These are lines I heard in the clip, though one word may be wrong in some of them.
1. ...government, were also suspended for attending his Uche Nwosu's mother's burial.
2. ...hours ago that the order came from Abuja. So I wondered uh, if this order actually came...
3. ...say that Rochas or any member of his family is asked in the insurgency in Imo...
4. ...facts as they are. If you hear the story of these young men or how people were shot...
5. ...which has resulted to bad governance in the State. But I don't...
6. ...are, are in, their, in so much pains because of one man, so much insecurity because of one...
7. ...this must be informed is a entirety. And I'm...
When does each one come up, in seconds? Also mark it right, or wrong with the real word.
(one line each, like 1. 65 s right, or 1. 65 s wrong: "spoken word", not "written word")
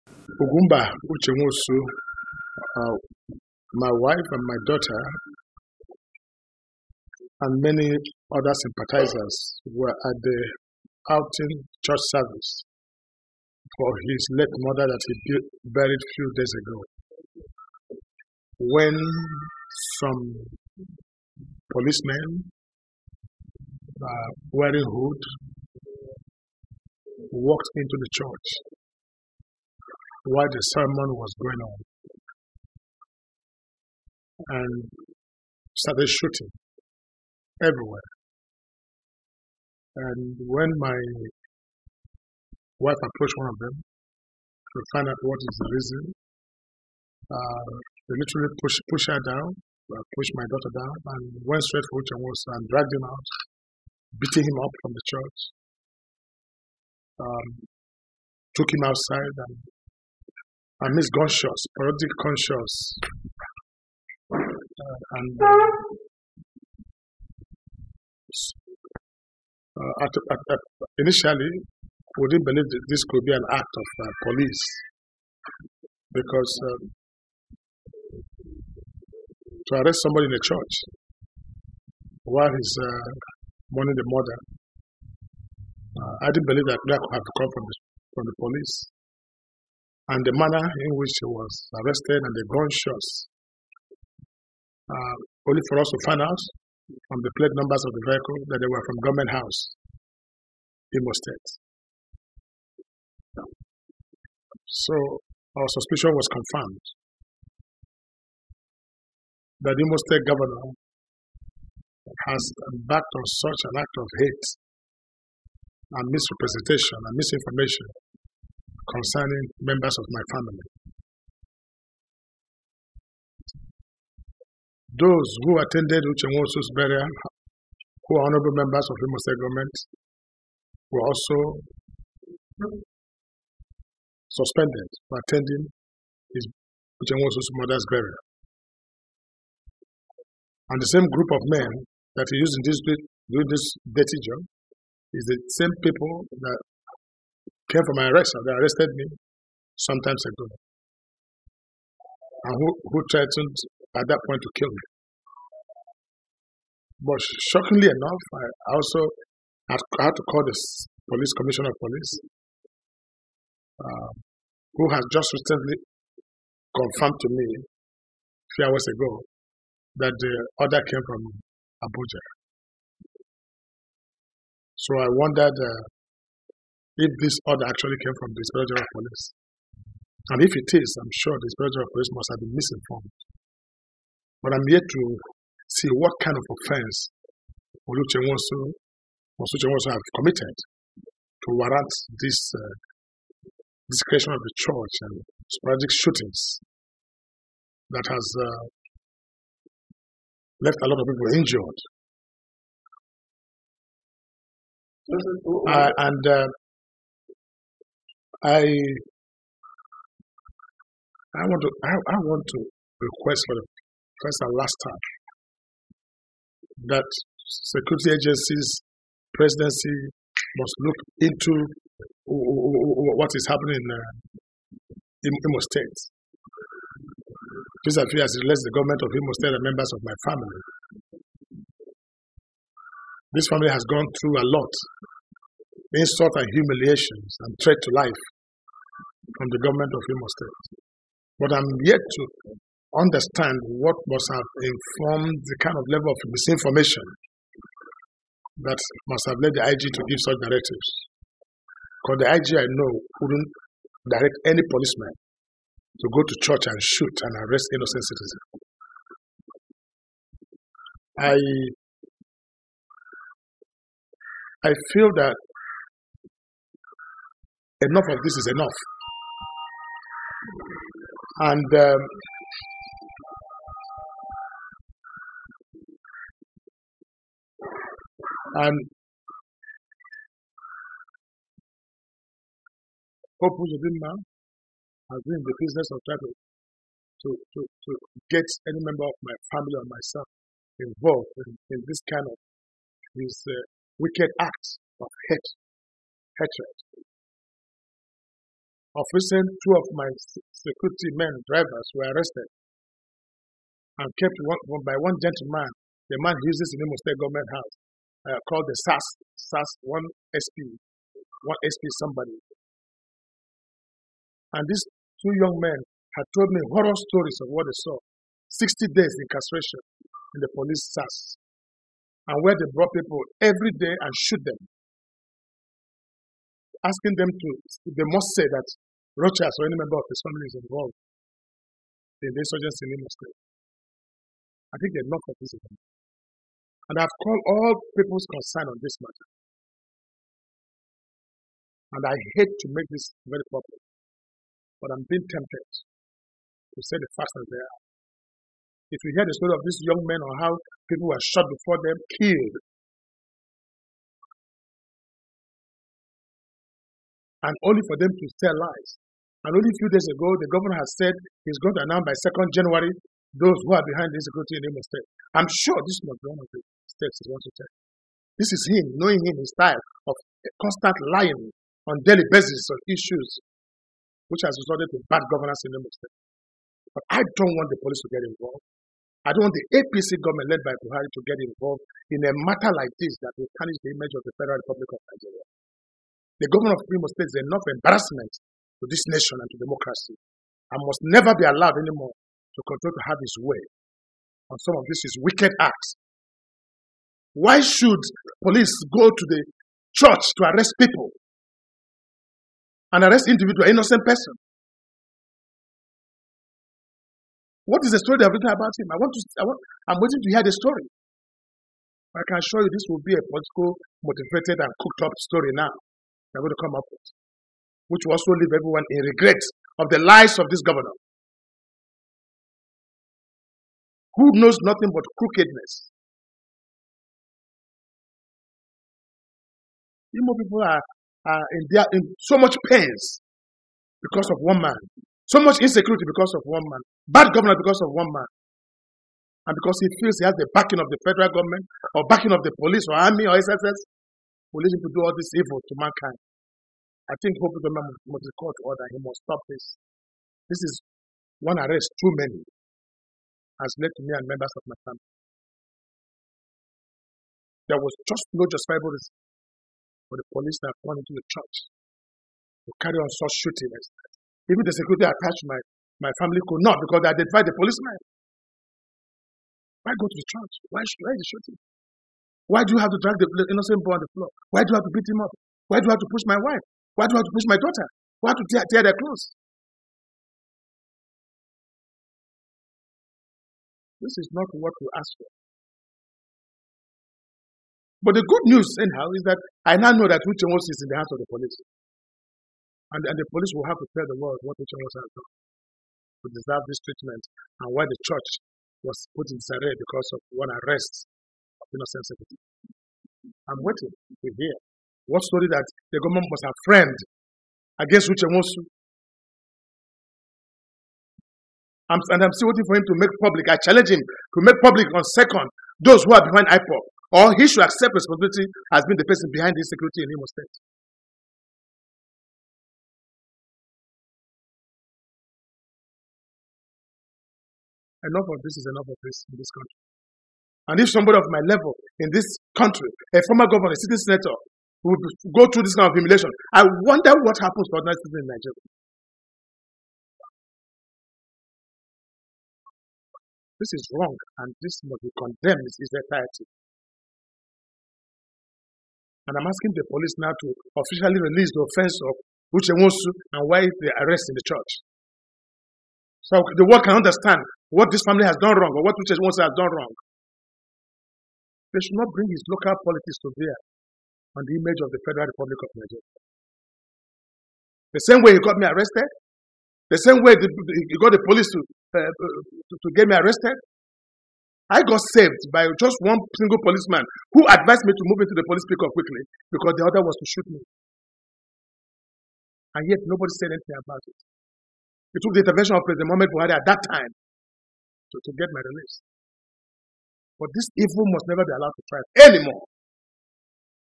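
1. 129 s right
2. 168 s right
3. 328 s wrong: "involved", not "asked"
4. 347 s right
5. 374 s right
6. 430 s right
7. 544 s wrong: "condemned", not "informed".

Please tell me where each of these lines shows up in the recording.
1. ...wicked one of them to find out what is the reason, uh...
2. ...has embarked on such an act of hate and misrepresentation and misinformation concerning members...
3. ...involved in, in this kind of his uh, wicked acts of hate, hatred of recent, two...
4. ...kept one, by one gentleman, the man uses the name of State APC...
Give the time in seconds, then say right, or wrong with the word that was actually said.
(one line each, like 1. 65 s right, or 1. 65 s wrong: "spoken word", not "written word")
1. 43 s wrong: "approached", not "wicked"
2. 112 s right
3. 290 s right
4. 304 s wrong: "Government", not "APC".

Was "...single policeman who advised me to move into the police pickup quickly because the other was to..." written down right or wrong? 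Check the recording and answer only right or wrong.
right.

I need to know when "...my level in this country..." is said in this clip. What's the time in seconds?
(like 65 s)
531 s.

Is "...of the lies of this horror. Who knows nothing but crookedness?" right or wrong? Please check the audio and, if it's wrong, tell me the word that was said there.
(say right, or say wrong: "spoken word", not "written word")
wrong: "governor", not "horror".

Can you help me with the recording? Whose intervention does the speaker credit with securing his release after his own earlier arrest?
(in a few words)
President Mohamed Buhari.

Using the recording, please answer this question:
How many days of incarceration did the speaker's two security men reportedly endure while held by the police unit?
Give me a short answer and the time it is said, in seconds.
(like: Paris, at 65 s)
60, at 318 s.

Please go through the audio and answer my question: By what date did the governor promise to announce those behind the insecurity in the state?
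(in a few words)
2nd January.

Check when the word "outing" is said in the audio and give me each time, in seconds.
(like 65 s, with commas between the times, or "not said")
11 s.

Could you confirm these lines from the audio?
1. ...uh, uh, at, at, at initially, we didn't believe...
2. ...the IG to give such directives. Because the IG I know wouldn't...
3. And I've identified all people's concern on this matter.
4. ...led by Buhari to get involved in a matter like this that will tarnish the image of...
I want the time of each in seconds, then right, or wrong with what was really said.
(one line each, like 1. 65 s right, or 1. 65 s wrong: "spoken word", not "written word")
1. 65 s right
2. 249 s right
3. 336 s wrong: "called", not "identified"
4. 380 s right.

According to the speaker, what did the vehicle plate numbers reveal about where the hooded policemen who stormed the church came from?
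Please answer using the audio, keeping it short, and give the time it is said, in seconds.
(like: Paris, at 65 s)
Government House, Imo State, at 99 s.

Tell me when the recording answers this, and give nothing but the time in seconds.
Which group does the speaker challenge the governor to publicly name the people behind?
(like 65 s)
516 s.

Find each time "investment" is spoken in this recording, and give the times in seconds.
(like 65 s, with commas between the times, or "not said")
not said.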